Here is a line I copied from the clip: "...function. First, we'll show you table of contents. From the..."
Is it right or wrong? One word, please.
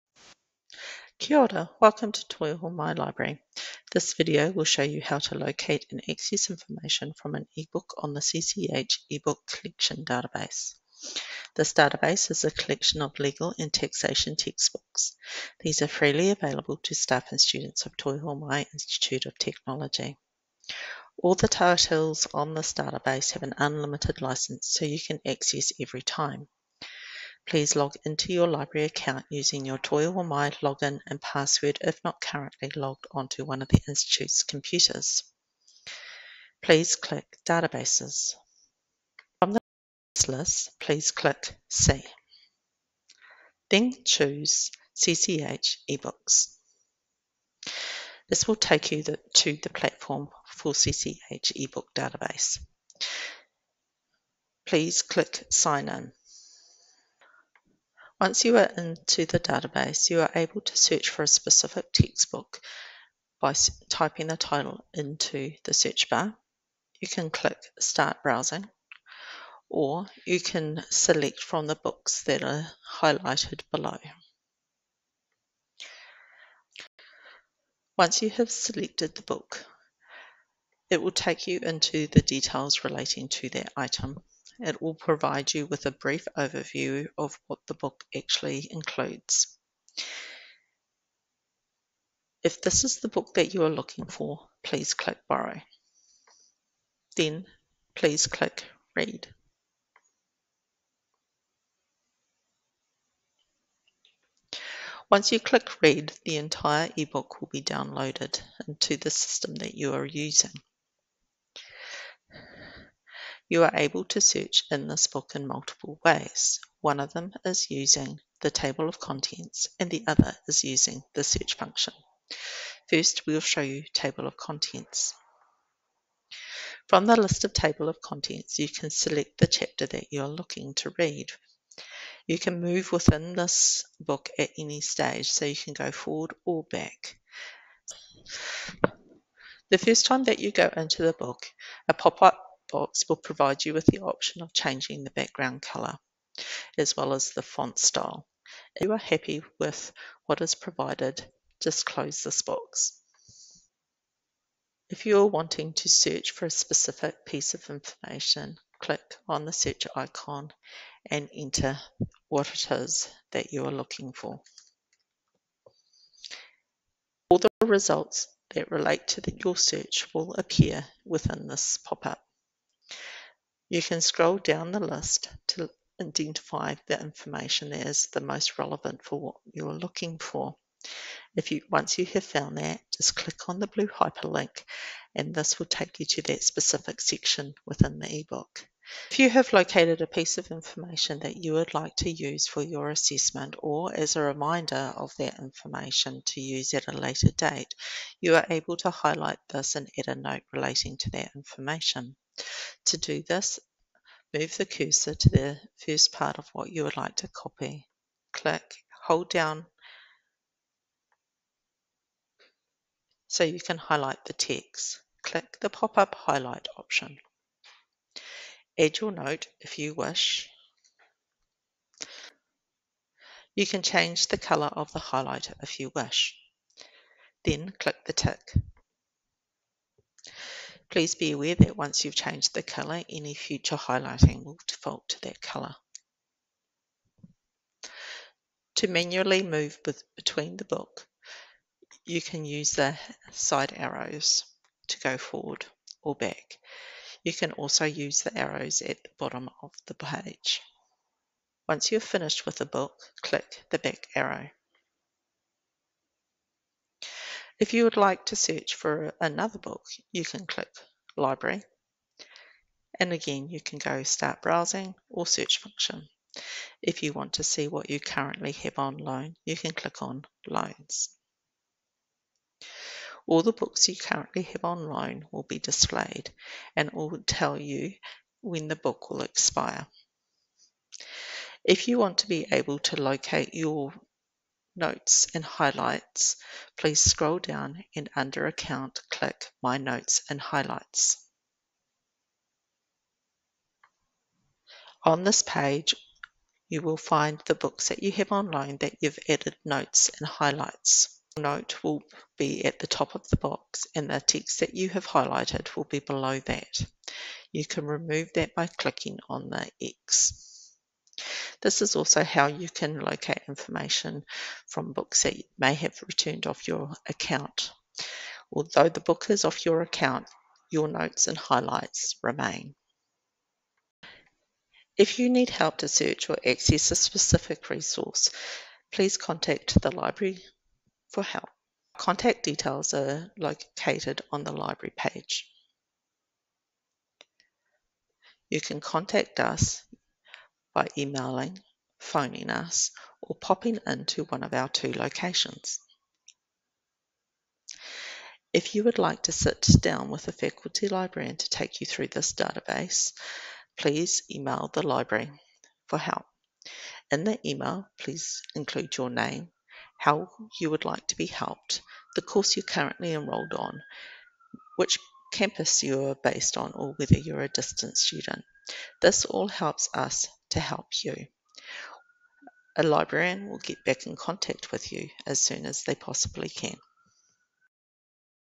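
right.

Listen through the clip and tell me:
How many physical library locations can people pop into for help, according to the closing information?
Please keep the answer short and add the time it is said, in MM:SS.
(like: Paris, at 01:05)
2, at 05:44.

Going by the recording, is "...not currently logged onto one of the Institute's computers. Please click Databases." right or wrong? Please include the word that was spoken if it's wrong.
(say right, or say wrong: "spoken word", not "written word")
right.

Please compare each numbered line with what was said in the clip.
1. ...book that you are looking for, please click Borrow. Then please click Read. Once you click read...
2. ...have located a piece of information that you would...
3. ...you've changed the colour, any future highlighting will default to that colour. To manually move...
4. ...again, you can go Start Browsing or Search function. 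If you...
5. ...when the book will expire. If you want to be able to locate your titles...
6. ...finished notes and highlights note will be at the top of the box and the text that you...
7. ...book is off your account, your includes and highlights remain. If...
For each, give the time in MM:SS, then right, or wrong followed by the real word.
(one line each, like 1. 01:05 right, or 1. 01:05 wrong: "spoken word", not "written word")
1. 01:33 right
2. 03:09 right
3. 03:52 right
4. 04:23 right
5. 04:38 wrong: "notes", not "titles"
6. 04:59 wrong: "added", not "finished"
7. 05:19 wrong: "notes", not "includes".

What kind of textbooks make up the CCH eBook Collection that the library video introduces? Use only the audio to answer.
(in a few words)
Legal and taxation.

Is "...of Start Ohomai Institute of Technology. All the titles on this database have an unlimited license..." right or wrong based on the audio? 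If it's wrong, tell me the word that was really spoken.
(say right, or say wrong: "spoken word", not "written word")
wrong: "Toi", not "Start".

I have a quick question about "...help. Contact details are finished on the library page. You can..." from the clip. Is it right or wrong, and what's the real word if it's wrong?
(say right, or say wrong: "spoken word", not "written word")
wrong: "located", not "finished".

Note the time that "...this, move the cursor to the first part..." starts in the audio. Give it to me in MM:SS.
03:23.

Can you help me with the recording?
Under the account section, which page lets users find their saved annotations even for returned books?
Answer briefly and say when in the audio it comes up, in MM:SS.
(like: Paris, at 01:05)
My Notes and Highlights, at 04:49.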